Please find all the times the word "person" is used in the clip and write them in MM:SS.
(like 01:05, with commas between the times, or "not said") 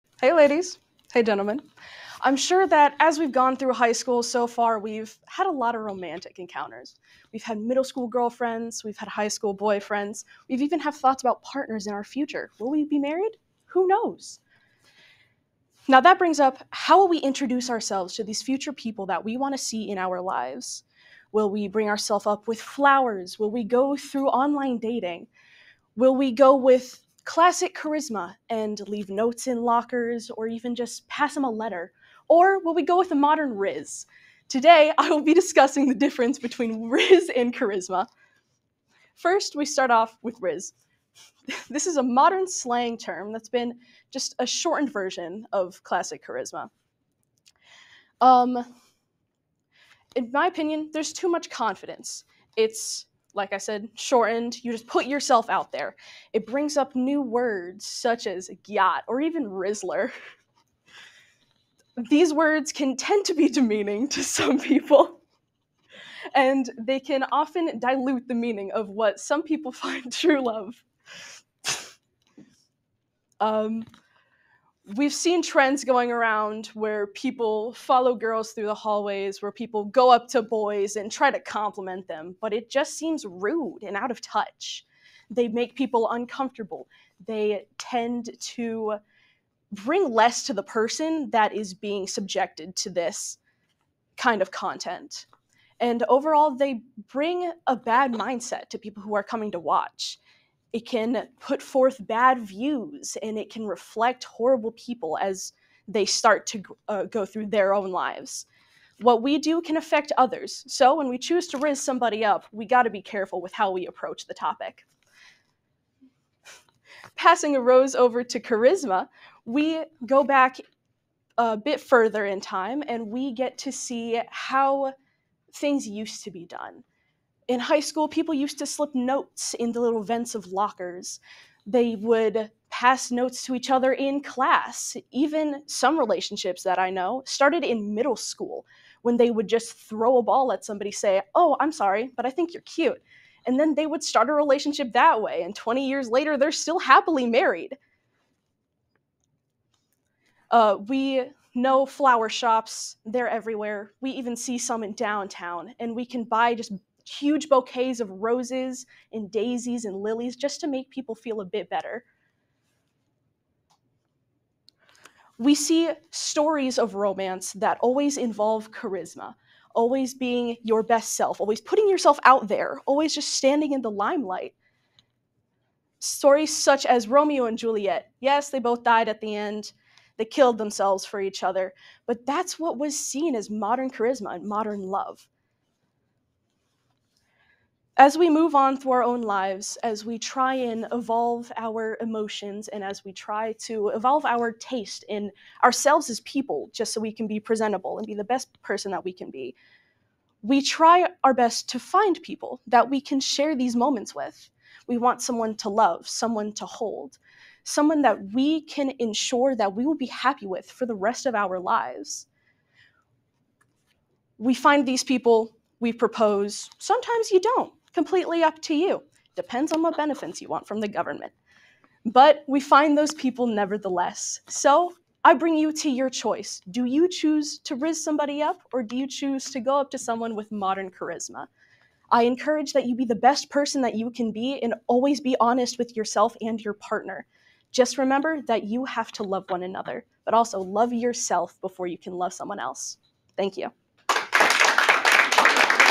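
01:30, 03:18, 03:53.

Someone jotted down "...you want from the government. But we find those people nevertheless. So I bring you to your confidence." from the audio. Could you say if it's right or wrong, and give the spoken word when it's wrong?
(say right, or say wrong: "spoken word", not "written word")
wrong: "choice", not "confidence".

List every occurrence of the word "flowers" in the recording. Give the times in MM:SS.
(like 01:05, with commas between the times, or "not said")
00:22, 02:31.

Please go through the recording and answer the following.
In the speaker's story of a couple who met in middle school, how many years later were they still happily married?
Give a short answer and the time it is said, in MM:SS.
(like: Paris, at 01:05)
20, at 02:25.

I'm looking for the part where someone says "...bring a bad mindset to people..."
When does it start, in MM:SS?
01:37.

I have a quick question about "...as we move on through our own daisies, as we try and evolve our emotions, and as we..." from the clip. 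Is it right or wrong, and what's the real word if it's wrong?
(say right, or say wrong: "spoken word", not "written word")
wrong: "lives", not "daisies".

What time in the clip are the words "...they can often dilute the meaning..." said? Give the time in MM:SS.
01:06.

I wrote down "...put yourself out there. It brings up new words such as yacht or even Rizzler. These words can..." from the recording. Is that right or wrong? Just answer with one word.
right.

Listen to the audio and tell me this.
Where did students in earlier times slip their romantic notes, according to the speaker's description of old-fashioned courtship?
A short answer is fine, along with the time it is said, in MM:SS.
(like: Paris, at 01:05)
vents of lockers, at 02:10.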